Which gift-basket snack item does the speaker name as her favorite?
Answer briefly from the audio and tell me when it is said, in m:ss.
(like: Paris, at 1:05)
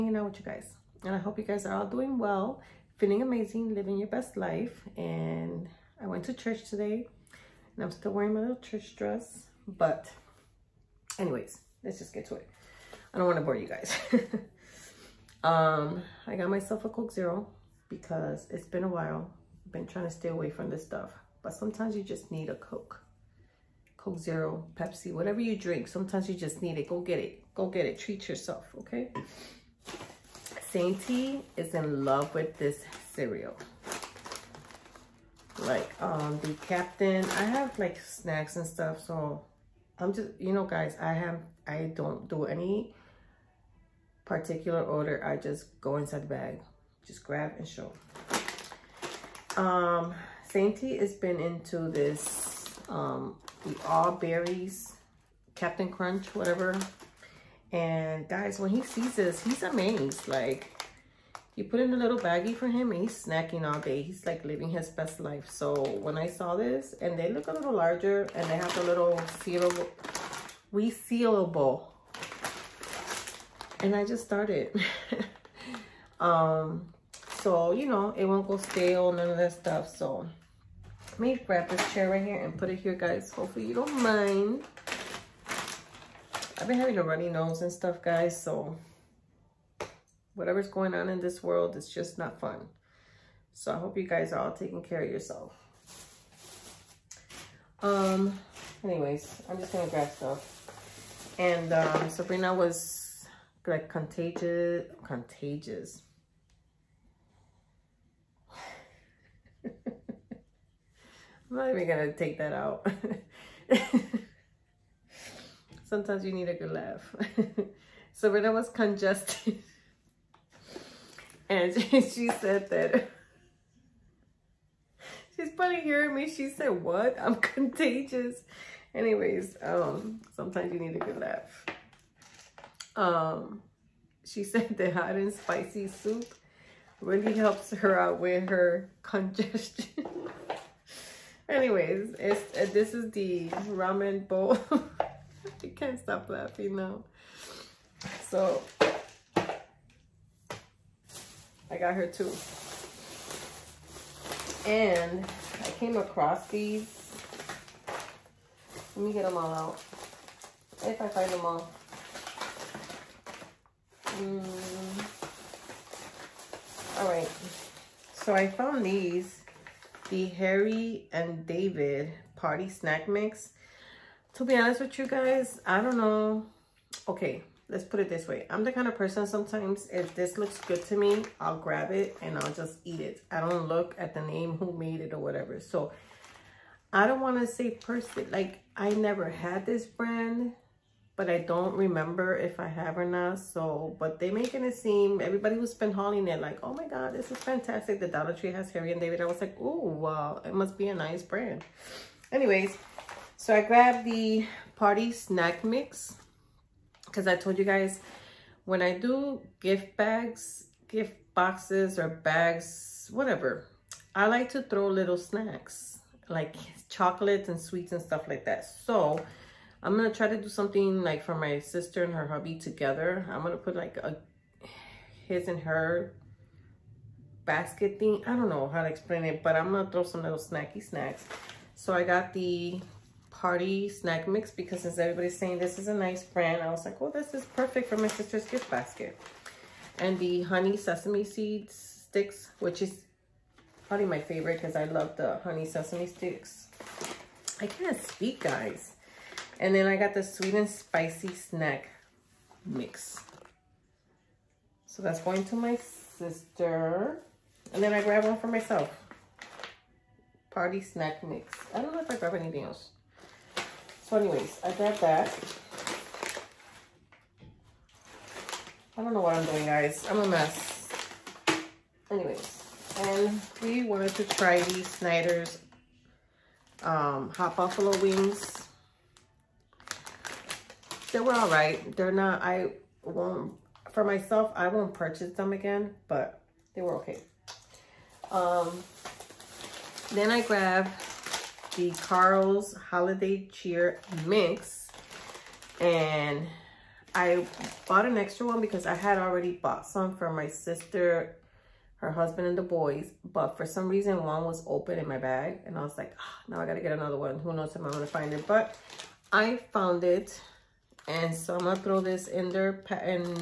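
Honey Sesame Seed Sticks, at 4:00.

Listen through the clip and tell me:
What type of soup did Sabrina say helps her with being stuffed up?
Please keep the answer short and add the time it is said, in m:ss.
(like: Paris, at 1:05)
Hot and spicy soup, at 2:14.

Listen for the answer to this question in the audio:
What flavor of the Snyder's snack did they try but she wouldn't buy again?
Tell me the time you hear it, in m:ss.
4:37.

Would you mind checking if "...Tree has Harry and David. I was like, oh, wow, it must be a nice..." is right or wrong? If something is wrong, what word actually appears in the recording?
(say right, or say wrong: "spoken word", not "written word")
right.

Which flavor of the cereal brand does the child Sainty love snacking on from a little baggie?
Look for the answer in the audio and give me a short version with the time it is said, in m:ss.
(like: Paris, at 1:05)
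All Berries, at 0:53.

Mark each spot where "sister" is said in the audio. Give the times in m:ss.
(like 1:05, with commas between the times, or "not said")
3:41, 3:58, 4:15, 5:00.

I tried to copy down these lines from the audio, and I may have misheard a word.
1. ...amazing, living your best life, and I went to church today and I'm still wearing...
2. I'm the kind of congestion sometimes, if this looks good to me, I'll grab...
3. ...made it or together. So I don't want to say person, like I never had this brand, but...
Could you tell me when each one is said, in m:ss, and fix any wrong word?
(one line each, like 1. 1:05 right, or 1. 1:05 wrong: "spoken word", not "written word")
1. 0:03 right
2. 2:58 wrong: "person", not "congestion"
3. 3:04 wrong: "whatever", not "together".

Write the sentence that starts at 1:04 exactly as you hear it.
He's like living his best life.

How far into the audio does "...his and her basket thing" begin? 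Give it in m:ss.
3:45.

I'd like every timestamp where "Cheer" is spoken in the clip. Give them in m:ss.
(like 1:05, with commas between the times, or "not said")
4:53.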